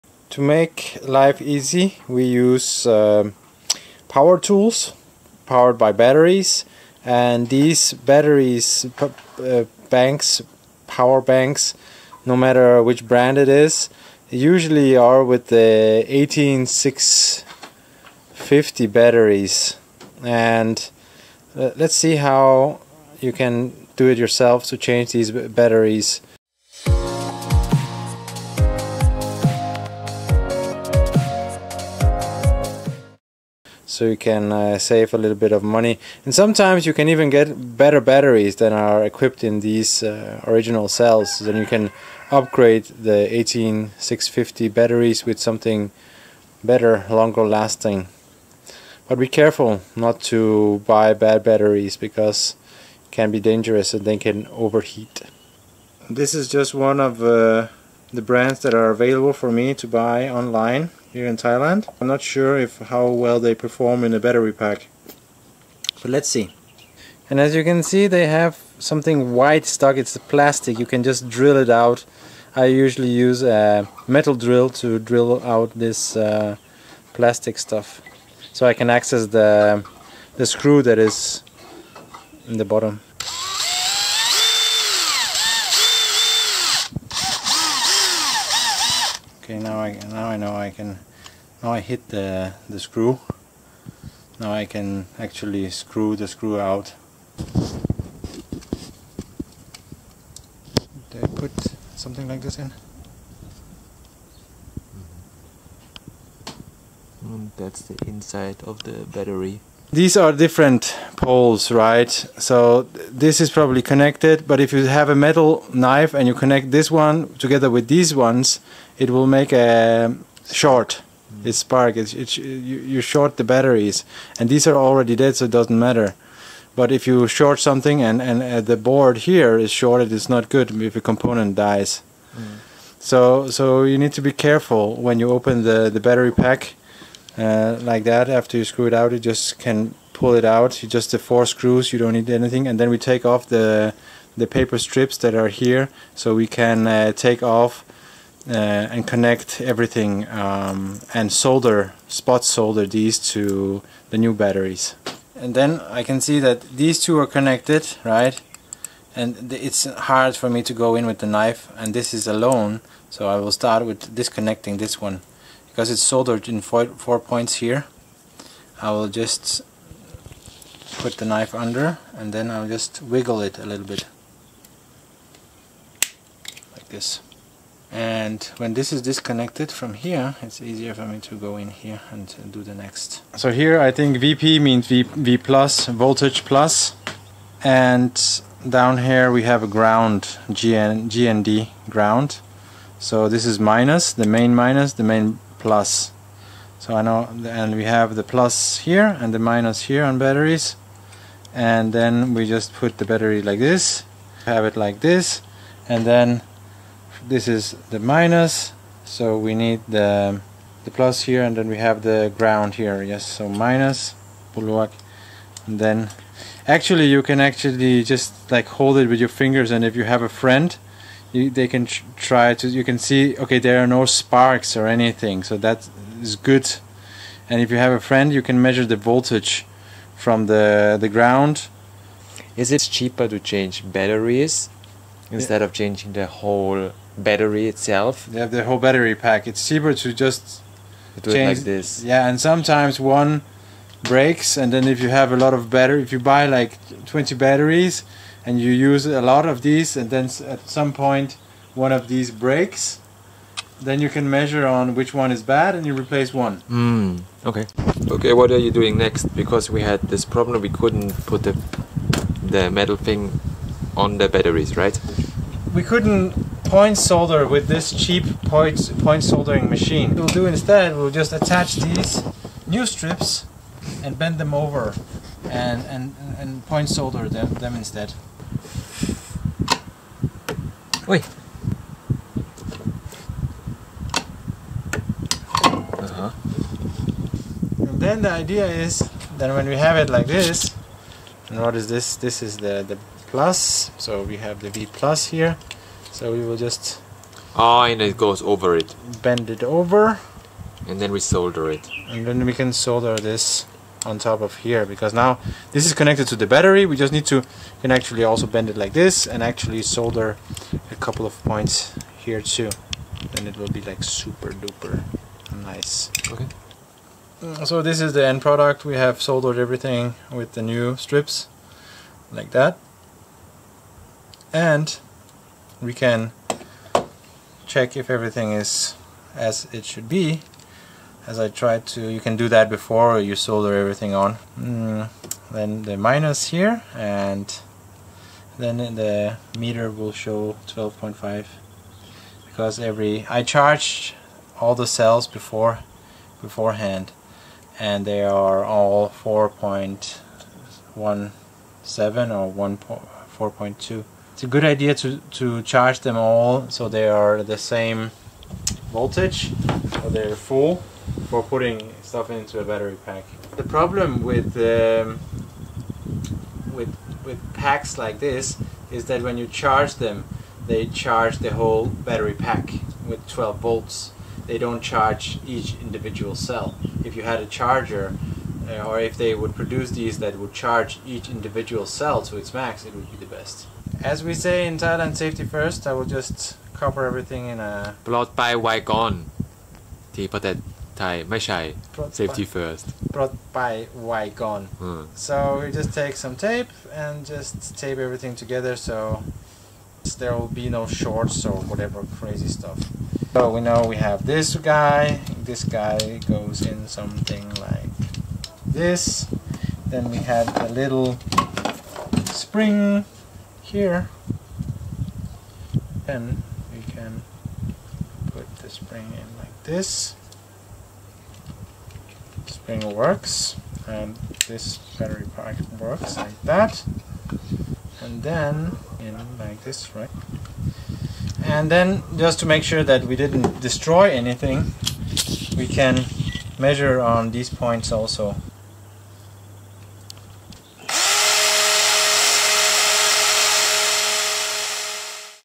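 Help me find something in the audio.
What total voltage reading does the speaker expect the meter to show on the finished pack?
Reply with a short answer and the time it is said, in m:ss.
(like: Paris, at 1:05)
12.5, at 5:40.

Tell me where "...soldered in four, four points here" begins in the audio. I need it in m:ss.
2:46.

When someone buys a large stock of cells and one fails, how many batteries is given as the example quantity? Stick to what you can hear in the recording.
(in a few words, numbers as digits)
20.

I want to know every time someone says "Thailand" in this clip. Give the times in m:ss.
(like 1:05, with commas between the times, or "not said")
1:01, 6:24.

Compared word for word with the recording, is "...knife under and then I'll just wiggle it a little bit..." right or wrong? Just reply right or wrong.
right.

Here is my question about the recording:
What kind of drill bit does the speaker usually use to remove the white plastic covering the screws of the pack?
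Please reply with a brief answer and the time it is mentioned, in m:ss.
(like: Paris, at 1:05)
metal drill, at 1:14.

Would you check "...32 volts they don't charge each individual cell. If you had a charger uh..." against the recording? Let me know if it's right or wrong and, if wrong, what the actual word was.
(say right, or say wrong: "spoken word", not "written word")
wrong: "12", not "32".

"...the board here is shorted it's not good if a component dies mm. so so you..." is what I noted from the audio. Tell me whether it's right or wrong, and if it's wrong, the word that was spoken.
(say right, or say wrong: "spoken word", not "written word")
right.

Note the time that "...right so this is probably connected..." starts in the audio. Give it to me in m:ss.
1:51.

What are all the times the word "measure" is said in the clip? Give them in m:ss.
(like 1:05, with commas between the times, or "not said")
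3:48, 4:14, 7:16.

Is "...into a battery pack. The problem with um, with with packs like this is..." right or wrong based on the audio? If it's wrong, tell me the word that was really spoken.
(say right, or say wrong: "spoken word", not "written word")
right.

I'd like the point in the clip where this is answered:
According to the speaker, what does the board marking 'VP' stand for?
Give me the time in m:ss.
3:05.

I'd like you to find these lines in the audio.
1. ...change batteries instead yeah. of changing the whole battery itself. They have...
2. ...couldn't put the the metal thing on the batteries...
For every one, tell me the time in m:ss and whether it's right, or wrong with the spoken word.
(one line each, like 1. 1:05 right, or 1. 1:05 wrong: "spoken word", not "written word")
1. 3:53 right
2. 4:20 right.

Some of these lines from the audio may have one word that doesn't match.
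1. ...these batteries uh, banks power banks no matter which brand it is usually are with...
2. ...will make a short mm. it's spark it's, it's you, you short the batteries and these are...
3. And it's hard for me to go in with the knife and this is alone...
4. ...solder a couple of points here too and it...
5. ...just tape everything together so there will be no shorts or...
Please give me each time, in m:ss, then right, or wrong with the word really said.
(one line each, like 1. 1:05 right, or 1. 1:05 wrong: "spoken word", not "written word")
1. 0:07 right
2. 1:59 right
3. 2:39 right
4. 5:09 right
5. 6:37 right.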